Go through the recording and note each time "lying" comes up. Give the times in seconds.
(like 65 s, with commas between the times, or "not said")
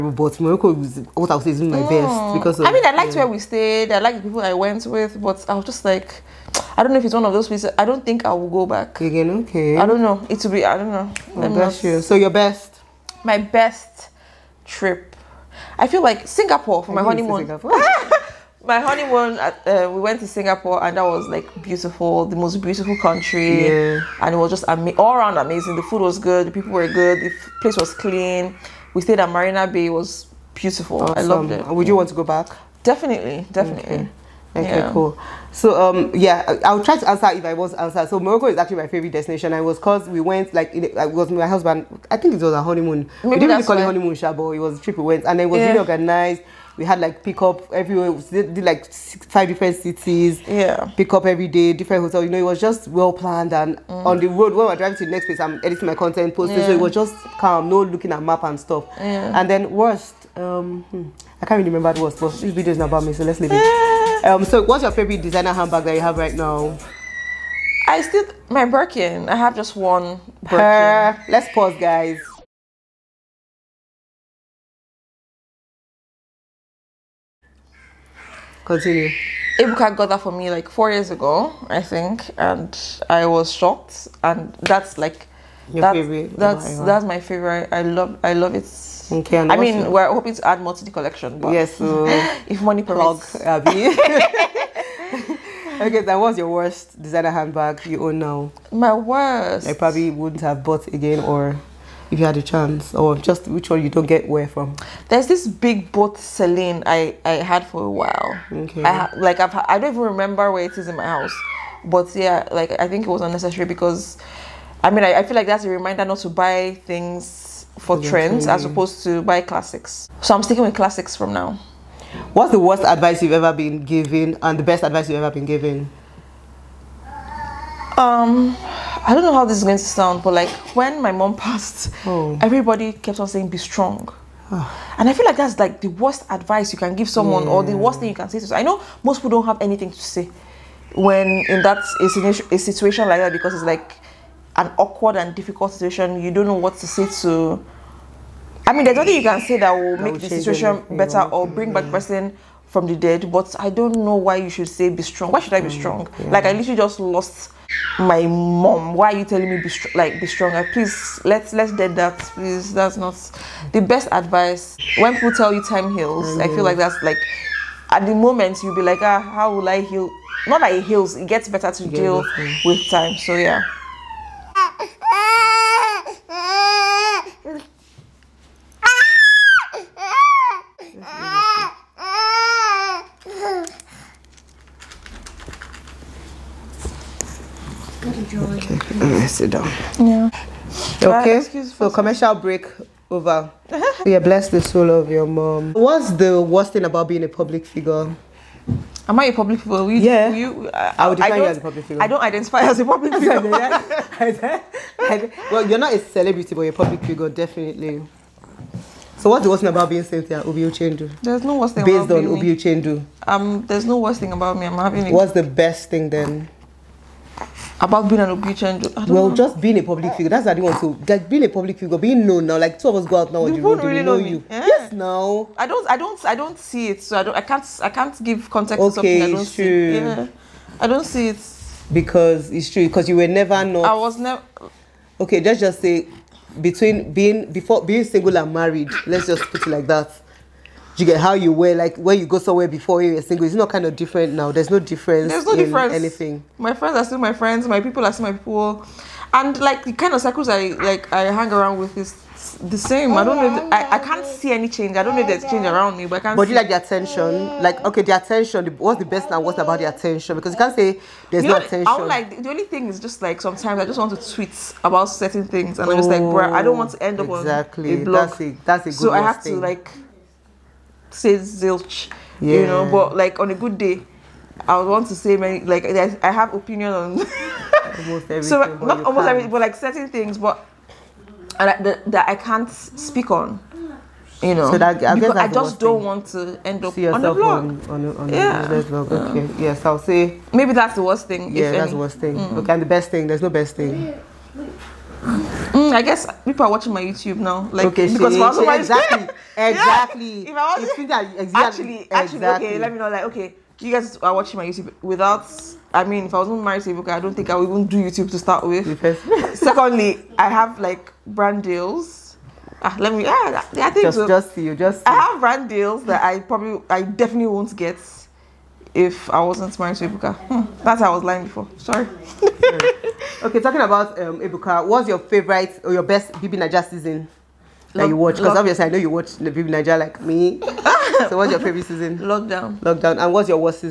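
321 s.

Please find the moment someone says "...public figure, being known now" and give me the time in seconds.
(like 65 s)
221 s.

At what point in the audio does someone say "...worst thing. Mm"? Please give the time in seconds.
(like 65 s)
291 s.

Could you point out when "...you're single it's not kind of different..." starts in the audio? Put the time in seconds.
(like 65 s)
243 s.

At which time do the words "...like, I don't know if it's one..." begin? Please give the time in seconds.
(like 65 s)
5 s.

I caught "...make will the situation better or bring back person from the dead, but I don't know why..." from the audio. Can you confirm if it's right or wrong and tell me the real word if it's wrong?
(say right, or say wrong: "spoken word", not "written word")
right.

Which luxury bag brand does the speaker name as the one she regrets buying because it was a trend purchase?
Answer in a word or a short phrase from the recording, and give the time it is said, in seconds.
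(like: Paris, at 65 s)
Celine, at 106 s.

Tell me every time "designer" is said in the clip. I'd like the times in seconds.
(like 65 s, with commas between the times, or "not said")
65 s, 96 s.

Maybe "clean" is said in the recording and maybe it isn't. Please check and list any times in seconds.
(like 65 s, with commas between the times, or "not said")
27 s.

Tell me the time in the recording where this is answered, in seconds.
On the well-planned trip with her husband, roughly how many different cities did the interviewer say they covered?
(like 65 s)
49 s.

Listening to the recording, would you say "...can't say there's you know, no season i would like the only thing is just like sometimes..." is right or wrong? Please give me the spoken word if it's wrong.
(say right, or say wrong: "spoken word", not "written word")
wrong: "attention", not "season".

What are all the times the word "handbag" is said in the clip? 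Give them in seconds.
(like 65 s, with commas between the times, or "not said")
65 s, 97 s.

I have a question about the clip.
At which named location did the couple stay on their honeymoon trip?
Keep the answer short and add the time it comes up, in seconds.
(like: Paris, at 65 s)
Marina Bay, at 29 s.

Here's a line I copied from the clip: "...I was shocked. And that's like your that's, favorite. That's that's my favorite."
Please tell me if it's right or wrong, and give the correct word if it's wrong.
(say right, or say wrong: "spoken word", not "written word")
right.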